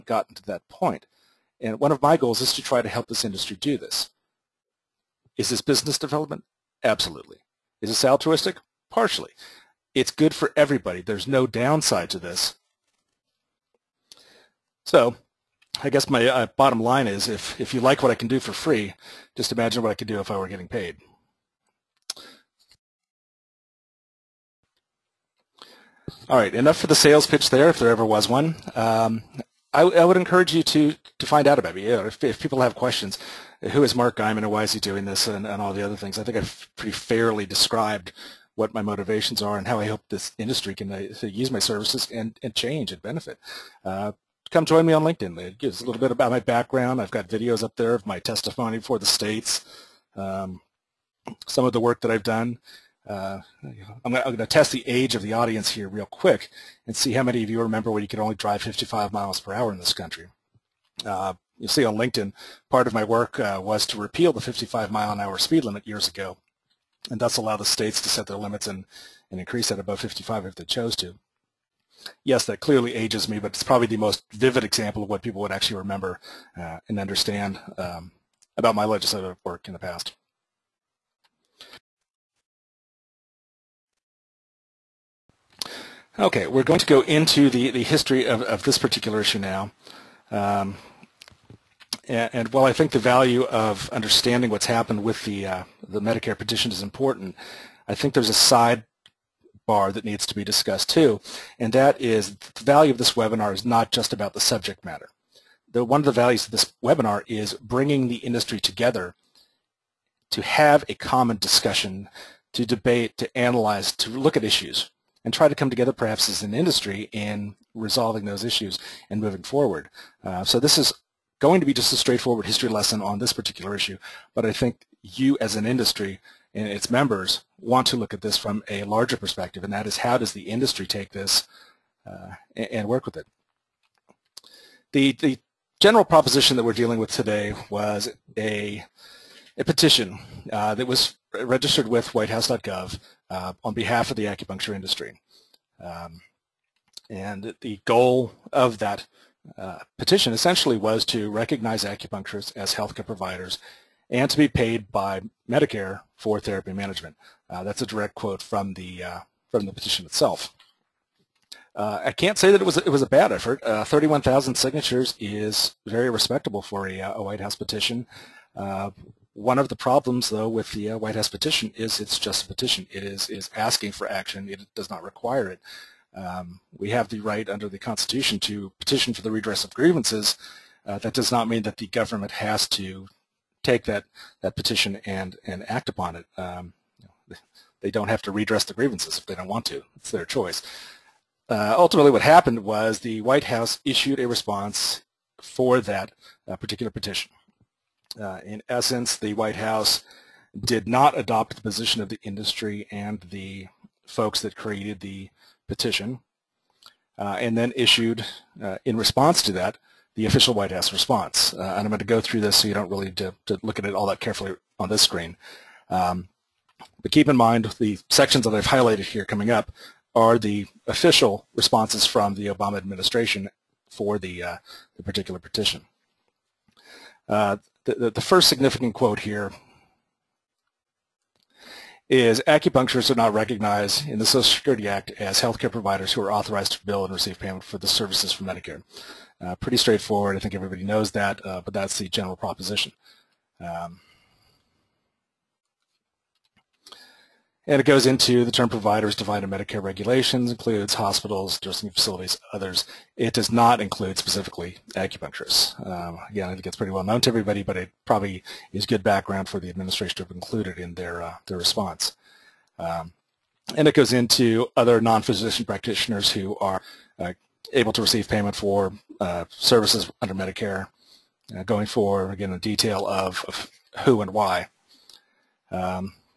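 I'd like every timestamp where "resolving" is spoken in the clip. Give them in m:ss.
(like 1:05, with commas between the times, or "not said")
1:57.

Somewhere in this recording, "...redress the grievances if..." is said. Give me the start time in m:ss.
3:08.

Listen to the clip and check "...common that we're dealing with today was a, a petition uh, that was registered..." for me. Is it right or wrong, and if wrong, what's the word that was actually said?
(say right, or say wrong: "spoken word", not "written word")
wrong: "proposition", not "common".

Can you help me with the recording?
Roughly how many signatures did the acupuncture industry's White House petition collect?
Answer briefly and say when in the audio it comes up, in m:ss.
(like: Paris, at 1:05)
31,000, at 2:43.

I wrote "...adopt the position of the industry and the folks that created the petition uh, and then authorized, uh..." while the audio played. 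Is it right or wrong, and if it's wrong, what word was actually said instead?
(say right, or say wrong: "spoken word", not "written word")
wrong: "issued", not "authorized".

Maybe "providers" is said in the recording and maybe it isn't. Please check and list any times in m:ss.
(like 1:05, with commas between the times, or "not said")
2:33, 3:55, 4:08.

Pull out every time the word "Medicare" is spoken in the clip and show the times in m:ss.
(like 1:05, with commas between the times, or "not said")
1:36, 2:35, 3:58, 4:09, 4:30.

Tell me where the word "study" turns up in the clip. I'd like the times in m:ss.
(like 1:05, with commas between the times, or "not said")
not said.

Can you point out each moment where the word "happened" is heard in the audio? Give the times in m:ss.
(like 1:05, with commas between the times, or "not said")
1:34, 3:12.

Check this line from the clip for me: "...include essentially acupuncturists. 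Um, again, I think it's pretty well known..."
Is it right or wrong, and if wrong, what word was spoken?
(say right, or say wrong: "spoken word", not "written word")
wrong: "specifically", not "essentially".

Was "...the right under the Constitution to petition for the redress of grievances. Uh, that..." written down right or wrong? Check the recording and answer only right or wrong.
right.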